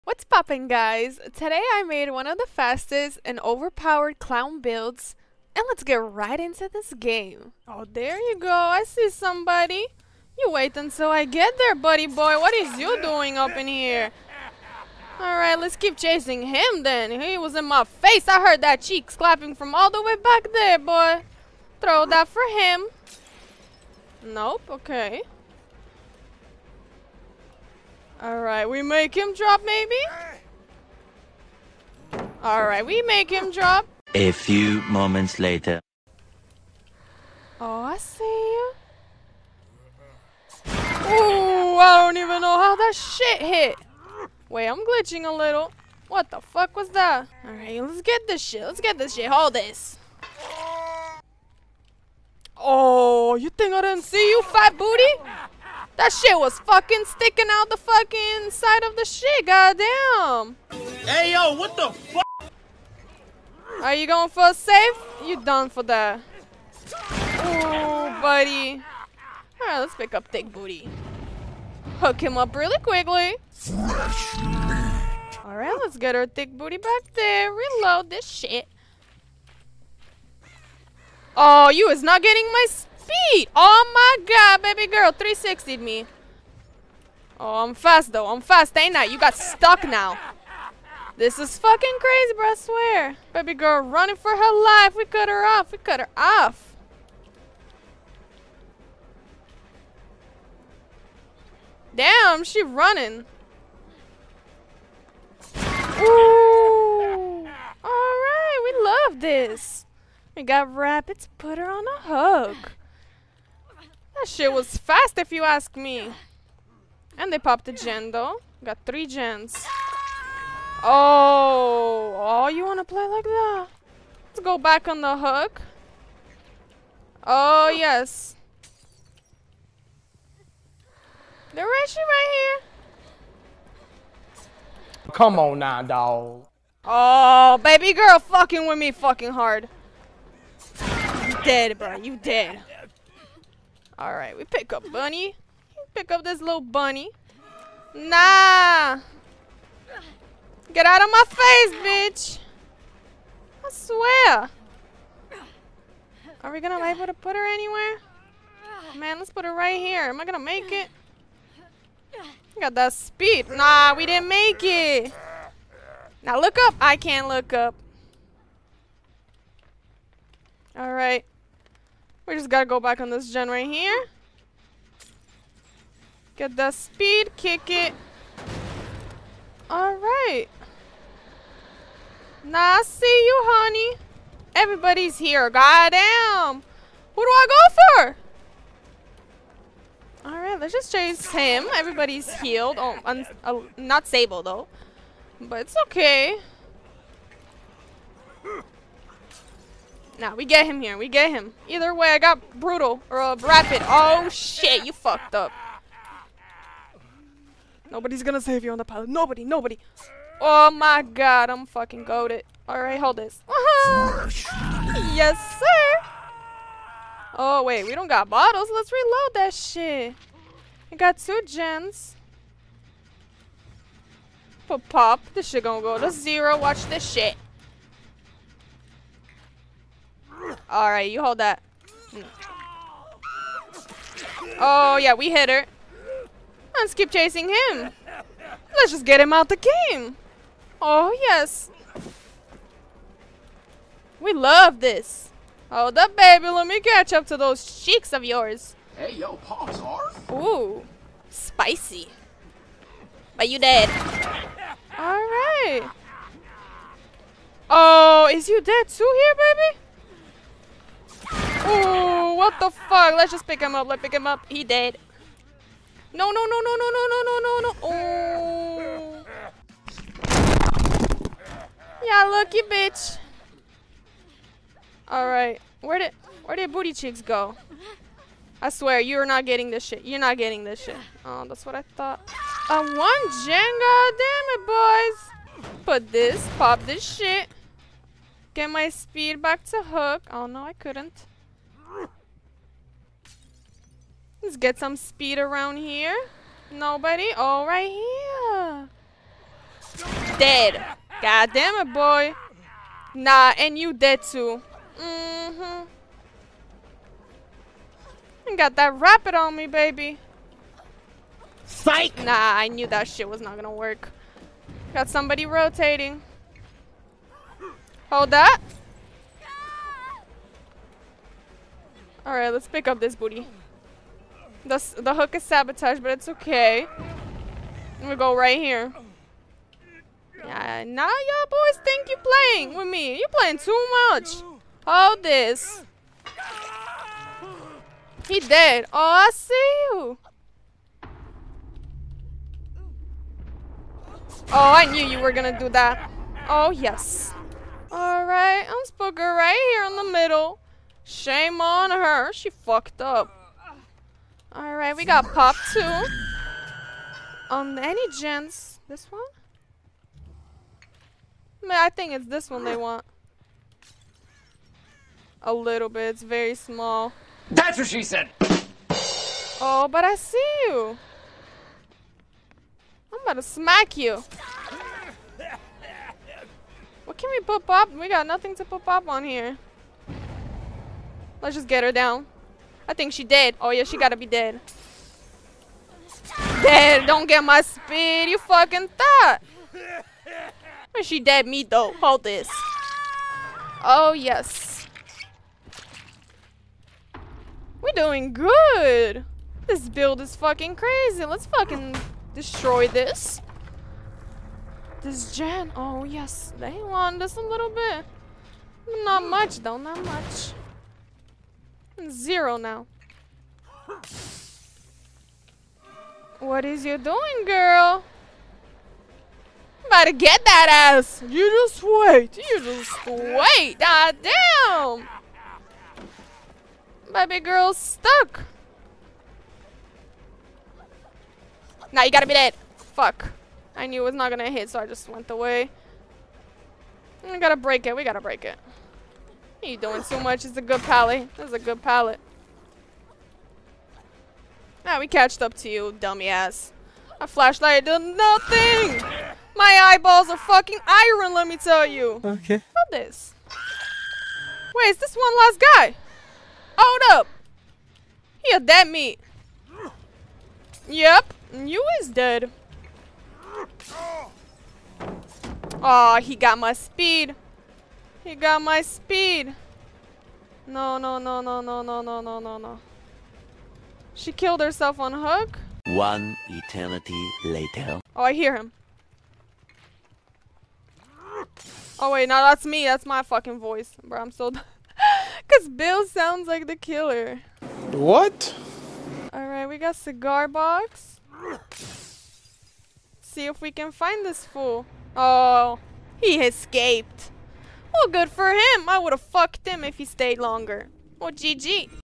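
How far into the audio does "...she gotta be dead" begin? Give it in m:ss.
6:23.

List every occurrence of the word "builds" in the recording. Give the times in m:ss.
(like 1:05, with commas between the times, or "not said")
0:04, 6:39.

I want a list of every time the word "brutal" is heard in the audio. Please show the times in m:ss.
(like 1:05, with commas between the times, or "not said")
3:22.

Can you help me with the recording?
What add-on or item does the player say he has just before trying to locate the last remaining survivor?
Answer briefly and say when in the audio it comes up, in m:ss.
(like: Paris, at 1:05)
Cigar box, at 8:09.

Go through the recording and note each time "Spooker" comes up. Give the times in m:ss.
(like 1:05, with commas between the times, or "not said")
5:48.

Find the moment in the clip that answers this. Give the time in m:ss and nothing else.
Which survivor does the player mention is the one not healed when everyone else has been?
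3:14.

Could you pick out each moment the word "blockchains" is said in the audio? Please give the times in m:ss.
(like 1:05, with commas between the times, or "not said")
not said.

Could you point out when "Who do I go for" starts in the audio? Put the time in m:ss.
3:07.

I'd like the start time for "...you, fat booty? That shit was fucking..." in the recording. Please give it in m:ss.
0:54.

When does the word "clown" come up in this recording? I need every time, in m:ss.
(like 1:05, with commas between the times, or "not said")
0:04.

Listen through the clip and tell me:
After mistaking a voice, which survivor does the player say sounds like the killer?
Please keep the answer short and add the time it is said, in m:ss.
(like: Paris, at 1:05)
Bill, at 8:05.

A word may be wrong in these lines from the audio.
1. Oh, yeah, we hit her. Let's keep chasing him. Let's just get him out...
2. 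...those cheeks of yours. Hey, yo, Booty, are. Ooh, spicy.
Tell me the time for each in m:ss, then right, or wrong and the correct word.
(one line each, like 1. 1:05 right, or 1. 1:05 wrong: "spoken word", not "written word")
1. 3:54 right
2. 4:07 wrong: "Pops", not "Booty".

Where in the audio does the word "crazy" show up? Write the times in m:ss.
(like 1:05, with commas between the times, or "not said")
1:31, 6:40.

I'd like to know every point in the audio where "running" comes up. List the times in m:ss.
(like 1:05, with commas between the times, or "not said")
1:33, 1:42.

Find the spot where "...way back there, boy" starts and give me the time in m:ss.
0:20.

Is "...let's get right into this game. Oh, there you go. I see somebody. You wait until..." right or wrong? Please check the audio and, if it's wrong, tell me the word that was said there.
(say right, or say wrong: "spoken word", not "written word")
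right.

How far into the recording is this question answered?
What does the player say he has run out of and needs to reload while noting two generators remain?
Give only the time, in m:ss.
3:38.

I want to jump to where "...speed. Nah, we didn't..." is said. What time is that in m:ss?
2:42.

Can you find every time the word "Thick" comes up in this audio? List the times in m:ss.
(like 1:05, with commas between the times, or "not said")
1:10, 1:16.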